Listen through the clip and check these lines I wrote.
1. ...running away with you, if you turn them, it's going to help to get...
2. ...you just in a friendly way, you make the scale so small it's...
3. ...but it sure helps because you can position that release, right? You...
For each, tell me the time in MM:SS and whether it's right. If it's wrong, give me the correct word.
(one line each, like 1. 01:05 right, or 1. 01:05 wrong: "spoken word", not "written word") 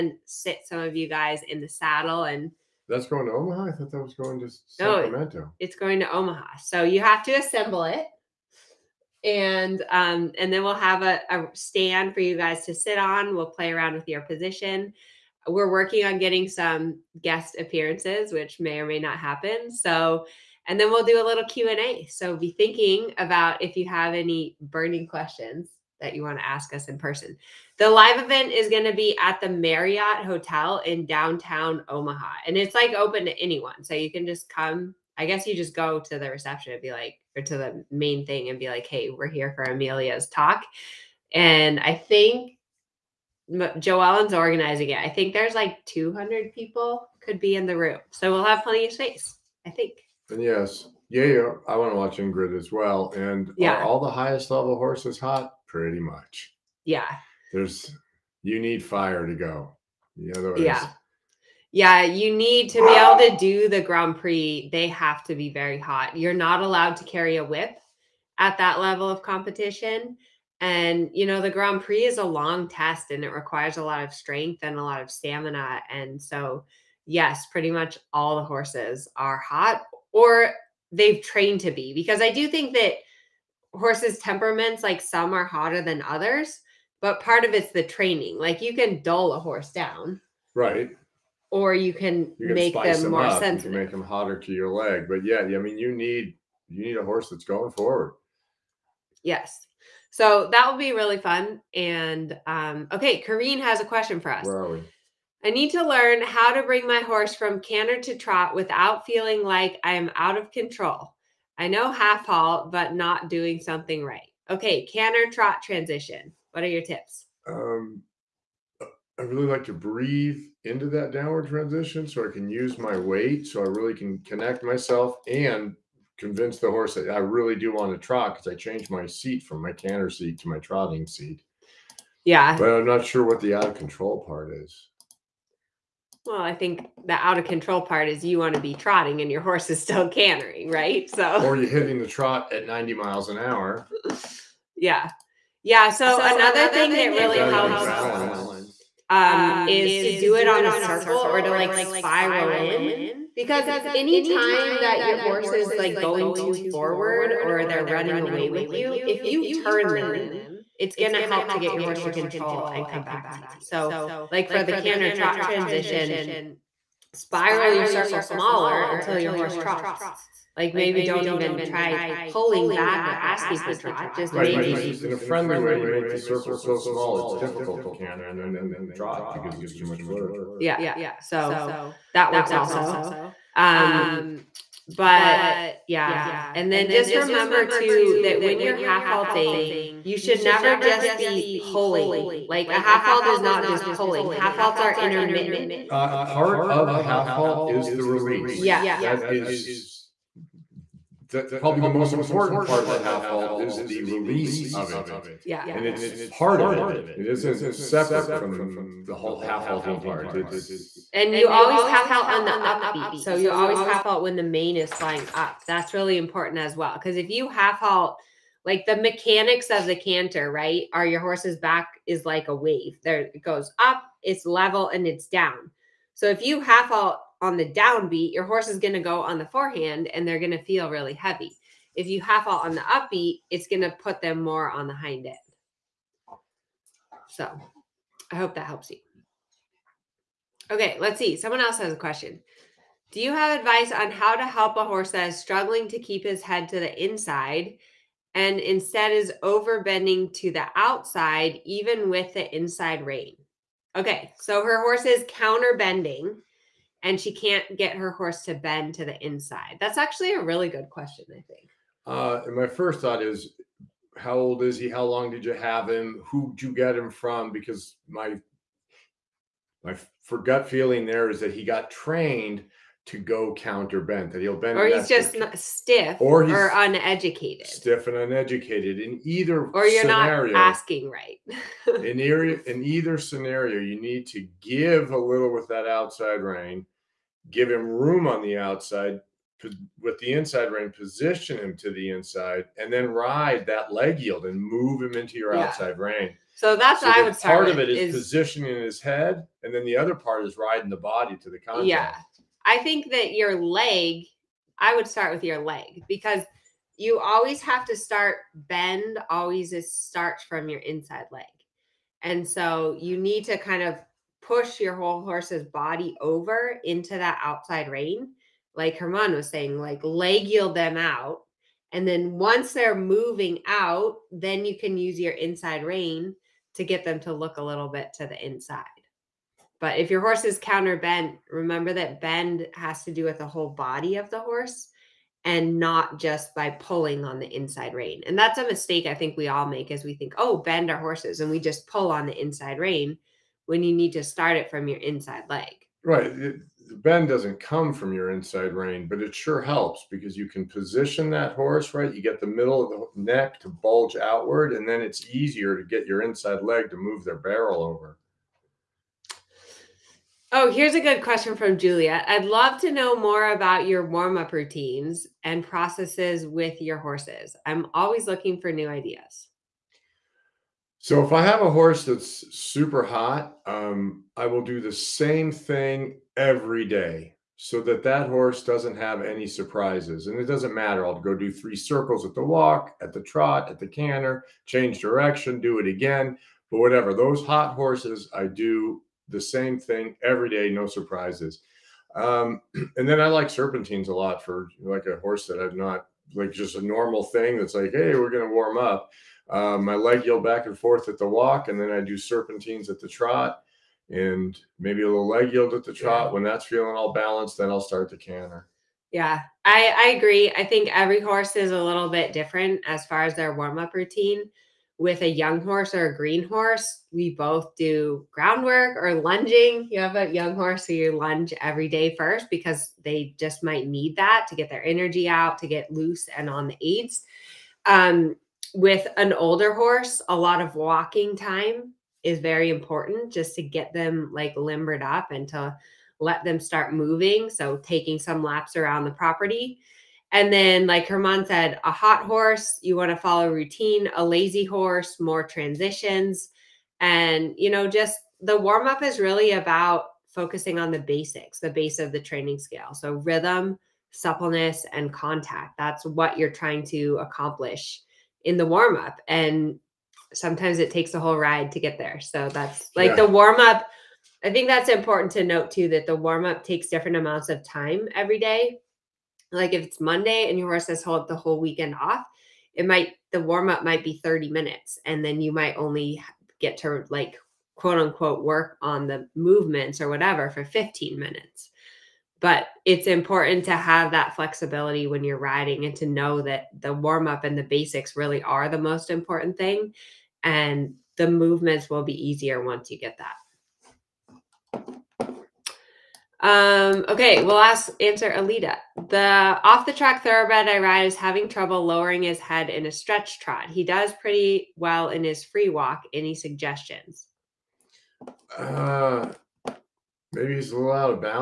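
1. 02:37 right
2. 02:54 wrong: "circle", not "scale"
3. 05:49 wrong: "horse", not "release".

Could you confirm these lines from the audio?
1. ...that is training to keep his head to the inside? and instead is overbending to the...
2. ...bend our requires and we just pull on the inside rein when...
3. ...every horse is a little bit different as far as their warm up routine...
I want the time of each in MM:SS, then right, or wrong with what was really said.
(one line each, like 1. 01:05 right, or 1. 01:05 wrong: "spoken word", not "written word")
1. 04:05 wrong: "struggling", not "training"
2. 05:40 wrong: "horses", not "requires"
3. 06:50 right.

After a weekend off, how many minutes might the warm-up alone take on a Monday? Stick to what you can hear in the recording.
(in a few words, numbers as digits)
30.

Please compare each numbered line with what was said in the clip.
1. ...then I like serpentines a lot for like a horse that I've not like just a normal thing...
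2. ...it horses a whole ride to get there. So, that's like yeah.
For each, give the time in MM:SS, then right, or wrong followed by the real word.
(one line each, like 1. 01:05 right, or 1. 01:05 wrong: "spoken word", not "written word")
1. 06:33 right
2. 07:40 wrong: "takes", not "horses".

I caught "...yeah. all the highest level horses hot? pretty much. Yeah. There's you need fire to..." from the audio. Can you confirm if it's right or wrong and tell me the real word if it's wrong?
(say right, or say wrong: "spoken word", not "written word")
right.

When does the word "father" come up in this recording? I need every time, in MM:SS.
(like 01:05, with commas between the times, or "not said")
not said.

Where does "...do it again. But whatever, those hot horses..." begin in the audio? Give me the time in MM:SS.
06:25.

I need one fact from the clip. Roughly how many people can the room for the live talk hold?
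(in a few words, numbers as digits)
200.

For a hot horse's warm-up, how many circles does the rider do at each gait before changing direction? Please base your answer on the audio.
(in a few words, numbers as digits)
3.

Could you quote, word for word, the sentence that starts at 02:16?
Well, I think the out of control part is you want to be trotting and your horse is still cantering, right?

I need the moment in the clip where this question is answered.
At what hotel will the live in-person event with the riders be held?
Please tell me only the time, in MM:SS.
00:29.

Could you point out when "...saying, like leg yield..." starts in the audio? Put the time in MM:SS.
05:19.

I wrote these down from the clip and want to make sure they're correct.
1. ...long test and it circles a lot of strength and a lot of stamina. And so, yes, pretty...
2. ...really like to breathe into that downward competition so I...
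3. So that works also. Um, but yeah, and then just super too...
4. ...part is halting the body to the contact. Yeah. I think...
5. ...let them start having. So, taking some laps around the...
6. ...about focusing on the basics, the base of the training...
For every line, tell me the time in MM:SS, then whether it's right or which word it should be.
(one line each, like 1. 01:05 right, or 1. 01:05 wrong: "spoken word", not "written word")
1. 01:12 wrong: "requires", not "circles"
2. 01:59 wrong: "transition", not "competition"
3. 03:01 wrong: "remember", not "super"
4. 05:00 wrong: "riding", not "halting"
5. 07:16 wrong: "moving", not "having"
6. 07:29 right.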